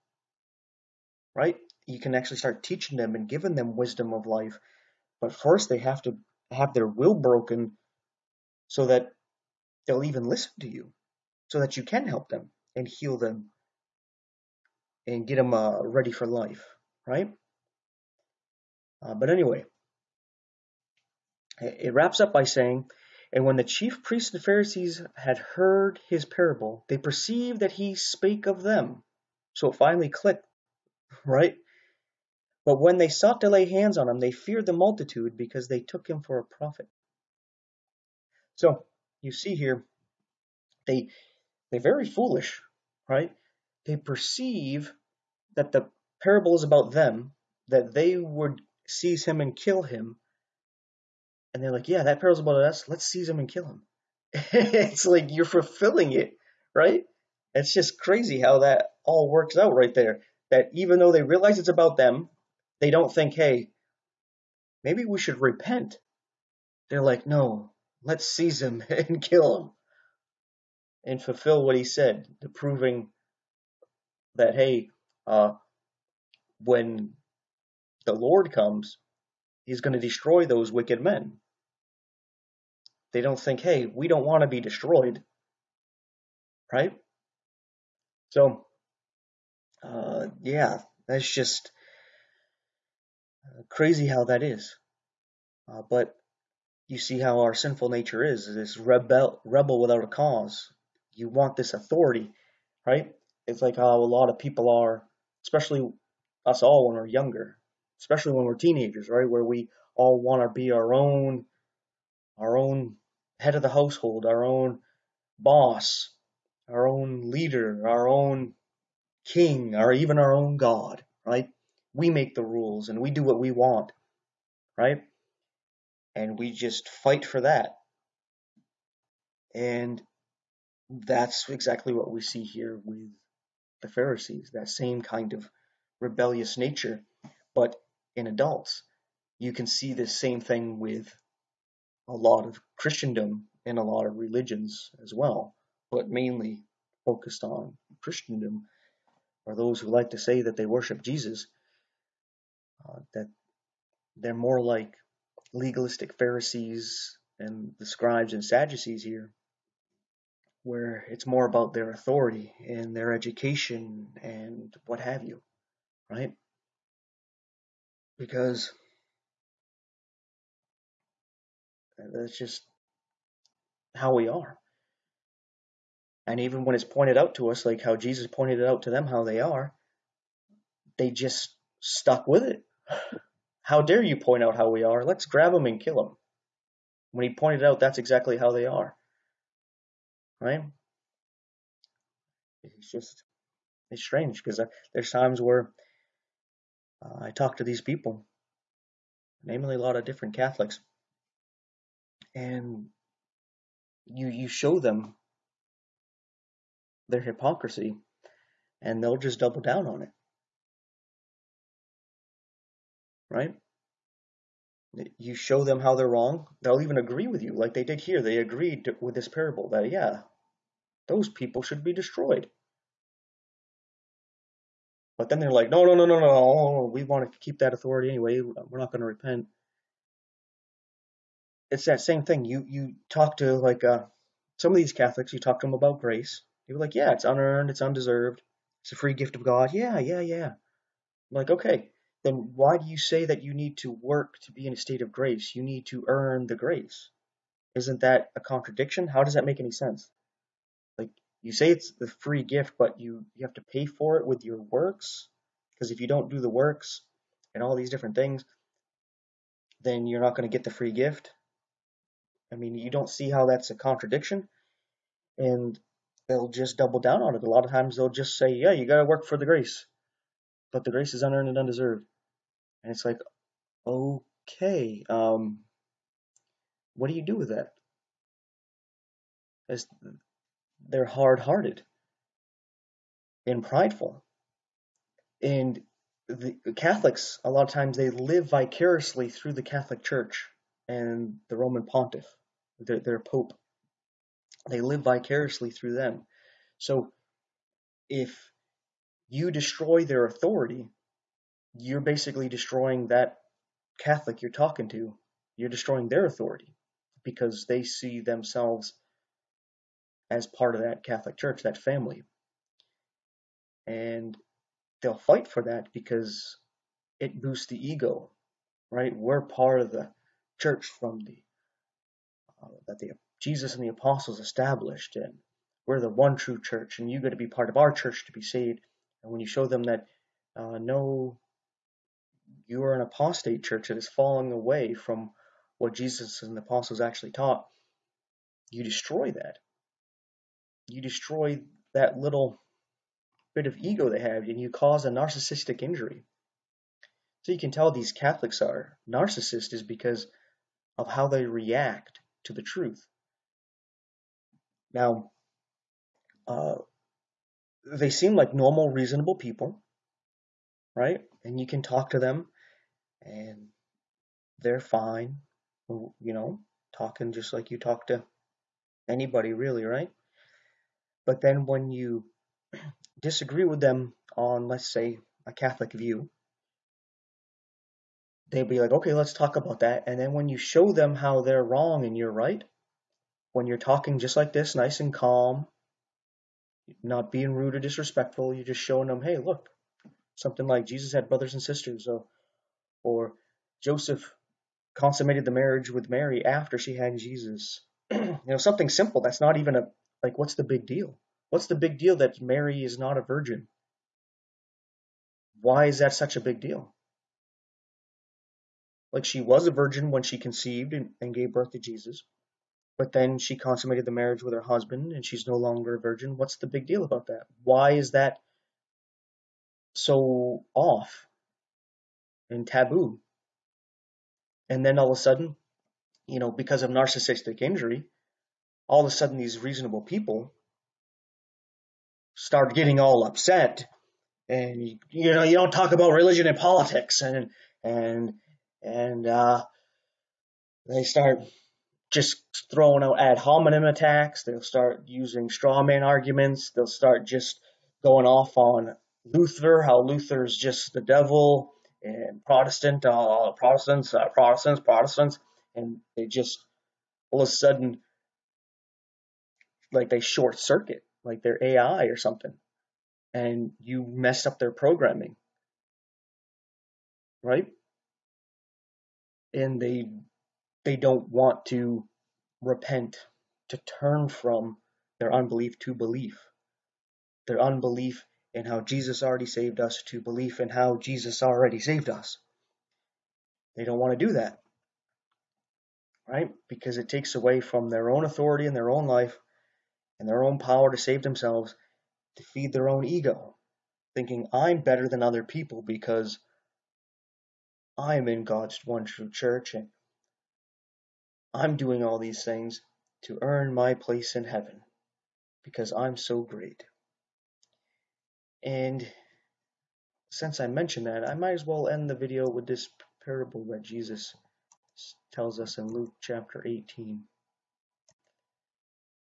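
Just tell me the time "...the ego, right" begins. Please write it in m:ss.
5:17.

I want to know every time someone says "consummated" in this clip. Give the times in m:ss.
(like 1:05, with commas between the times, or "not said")
6:34, 6:53.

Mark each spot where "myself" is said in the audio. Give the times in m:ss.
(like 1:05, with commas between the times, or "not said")
not said.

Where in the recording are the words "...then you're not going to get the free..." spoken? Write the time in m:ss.
4:19.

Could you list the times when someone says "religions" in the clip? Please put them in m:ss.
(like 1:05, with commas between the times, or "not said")
2:24, 7:16.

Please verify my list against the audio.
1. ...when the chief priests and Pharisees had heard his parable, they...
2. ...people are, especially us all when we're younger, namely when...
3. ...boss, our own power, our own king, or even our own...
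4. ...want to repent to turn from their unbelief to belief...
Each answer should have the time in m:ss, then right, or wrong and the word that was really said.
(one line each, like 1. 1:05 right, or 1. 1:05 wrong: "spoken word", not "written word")
1. 0:23 right
2. 1:44 wrong: "especially", not "namely"
3. 1:55 wrong: "leader", not "power"
4. 7:51 right.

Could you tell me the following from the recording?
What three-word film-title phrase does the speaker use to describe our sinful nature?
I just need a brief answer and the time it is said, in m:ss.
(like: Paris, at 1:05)
Rebel without a cause, at 1:39.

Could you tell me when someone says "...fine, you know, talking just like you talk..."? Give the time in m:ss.
6:04.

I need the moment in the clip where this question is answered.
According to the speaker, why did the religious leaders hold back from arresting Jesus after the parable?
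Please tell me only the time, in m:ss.
0:34.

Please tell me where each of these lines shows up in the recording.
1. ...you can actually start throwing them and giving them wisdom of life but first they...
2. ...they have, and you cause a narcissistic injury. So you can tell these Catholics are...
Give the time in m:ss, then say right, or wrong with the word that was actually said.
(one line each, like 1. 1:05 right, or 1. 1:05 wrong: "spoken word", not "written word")
1. 0:01 wrong: "teaching", not "throwing"
2. 5:44 right.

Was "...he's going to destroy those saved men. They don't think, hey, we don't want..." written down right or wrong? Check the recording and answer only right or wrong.
wrong.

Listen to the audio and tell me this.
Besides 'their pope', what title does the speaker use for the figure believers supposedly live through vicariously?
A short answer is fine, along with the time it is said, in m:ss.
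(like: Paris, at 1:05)
Roman Pontiff, at 4:51.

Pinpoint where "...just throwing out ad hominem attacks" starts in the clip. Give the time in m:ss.
7:22.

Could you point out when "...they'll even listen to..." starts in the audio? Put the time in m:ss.
0:09.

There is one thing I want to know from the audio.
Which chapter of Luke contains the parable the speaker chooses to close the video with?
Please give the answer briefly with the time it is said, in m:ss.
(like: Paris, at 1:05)
18, at 8:36.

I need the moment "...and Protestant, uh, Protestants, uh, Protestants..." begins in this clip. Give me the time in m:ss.
7:32.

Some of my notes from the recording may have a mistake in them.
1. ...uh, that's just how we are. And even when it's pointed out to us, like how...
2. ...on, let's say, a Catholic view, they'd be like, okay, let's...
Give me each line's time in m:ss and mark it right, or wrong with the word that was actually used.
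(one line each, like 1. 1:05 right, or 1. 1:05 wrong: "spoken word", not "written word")
1. 2:52 right
2. 6:14 right.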